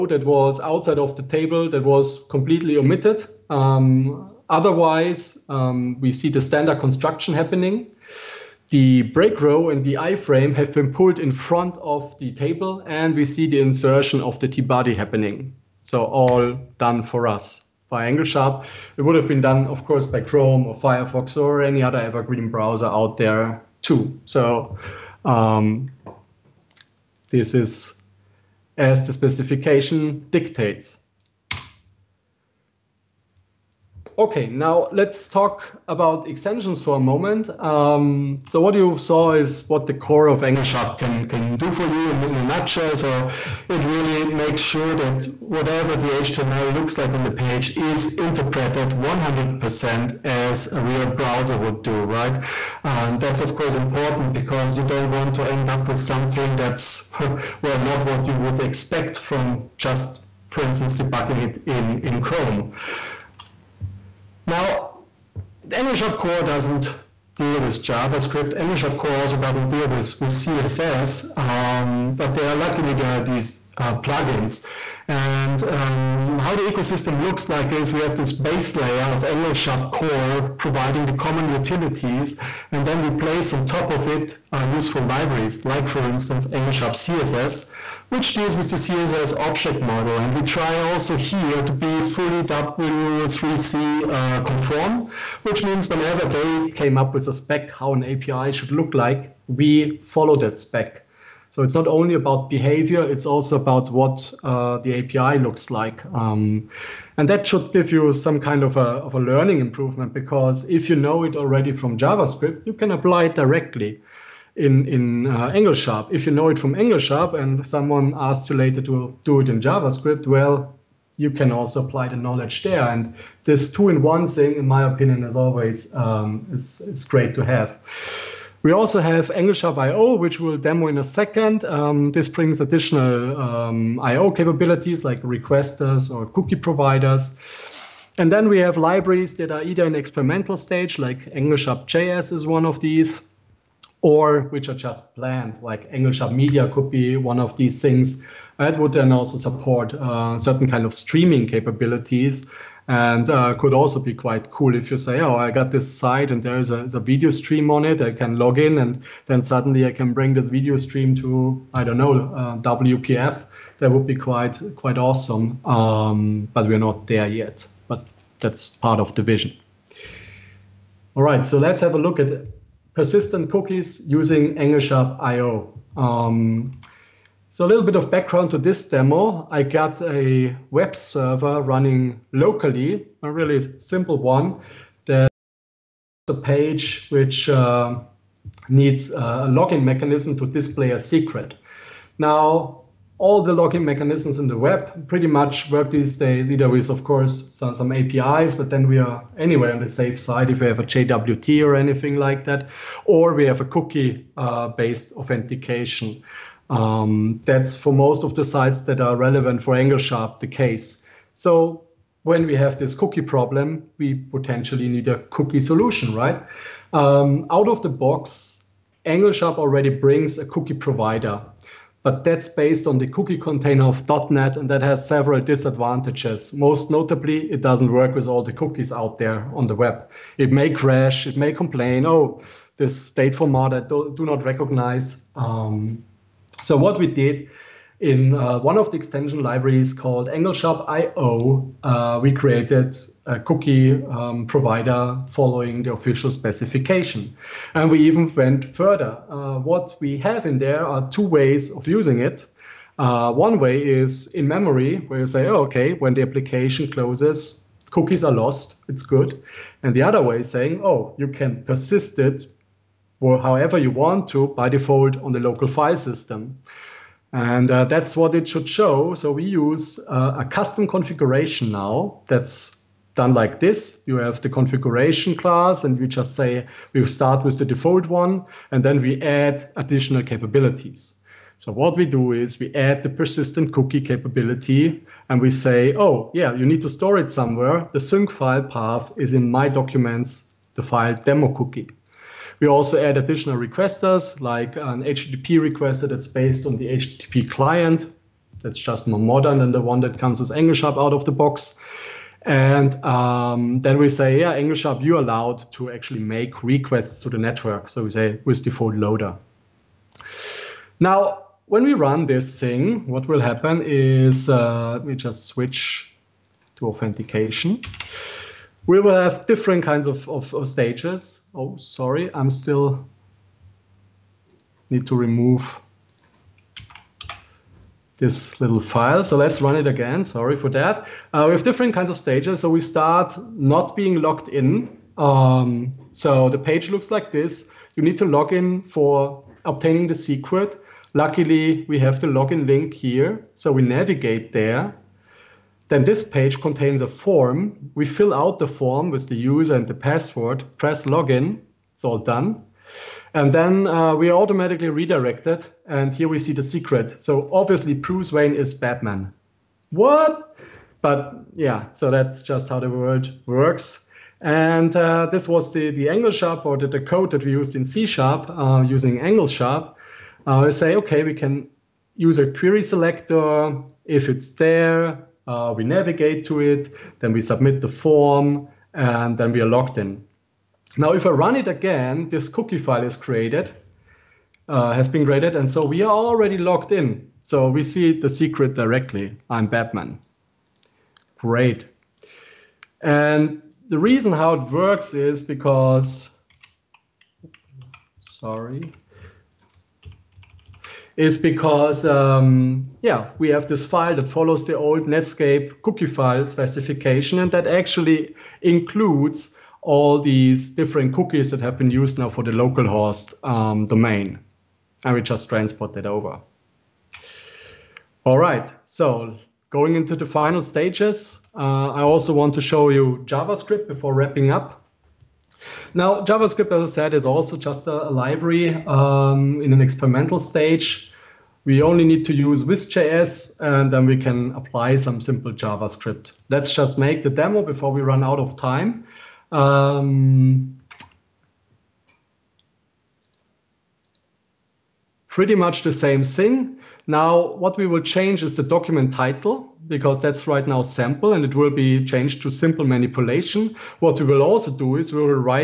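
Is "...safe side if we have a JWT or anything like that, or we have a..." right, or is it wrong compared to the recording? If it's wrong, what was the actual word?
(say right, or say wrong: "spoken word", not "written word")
right.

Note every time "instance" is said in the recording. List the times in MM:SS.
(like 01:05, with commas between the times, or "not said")
01:00, 01:26.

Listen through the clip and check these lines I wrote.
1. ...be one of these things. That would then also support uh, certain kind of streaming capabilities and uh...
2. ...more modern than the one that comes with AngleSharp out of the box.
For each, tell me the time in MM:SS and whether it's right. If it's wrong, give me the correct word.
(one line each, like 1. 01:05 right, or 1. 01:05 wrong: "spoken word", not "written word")
1. 02:26 right
2. 04:59 right.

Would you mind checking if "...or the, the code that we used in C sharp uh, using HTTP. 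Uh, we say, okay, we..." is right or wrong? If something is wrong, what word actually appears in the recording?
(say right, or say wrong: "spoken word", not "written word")
wrong: "AngleSharp", not "HTTP".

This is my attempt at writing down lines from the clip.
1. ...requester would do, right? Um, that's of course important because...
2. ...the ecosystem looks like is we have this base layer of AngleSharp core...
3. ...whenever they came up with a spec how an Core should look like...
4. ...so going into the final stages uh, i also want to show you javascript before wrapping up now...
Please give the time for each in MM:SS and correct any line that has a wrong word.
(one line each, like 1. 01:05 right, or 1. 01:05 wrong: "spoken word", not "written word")
1. 00:51 wrong: "browser", not "requester"
2. 01:16 right
3. 01:35 wrong: "API", not "Core"
4. 06:58 right.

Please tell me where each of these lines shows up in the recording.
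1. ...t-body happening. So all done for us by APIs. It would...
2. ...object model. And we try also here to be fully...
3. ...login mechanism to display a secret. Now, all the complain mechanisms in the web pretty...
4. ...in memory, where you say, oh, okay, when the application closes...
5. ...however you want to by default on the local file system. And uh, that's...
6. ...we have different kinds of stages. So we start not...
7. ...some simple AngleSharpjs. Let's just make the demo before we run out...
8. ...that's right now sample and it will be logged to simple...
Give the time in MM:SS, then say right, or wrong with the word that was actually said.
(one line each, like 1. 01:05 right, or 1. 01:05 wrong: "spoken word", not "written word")
1. 00:14 wrong: "AngleSharp", not "APIs"
2. 01:29 right
3. 03:09 wrong: "login", not "complain"
4. 04:14 right
5. 04:23 right
6. 05:31 right
7. 07:14 wrong: "JavaScript", not "AngleSharpjs"
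8. 07:30 wrong: "changed", not "logged".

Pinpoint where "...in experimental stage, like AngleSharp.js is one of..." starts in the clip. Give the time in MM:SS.
02:19.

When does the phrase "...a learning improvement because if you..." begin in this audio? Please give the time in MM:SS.
01:49.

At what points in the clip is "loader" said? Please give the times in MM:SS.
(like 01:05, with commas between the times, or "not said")
05:08.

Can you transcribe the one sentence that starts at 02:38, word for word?
I can log in and then suddenly I can bring this video stream to, I don't know, uh, WPF.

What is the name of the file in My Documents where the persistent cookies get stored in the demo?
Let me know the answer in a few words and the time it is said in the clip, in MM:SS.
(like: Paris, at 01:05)
demo cookie, at 04:51.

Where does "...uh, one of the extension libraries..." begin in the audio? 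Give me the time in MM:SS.
03:58.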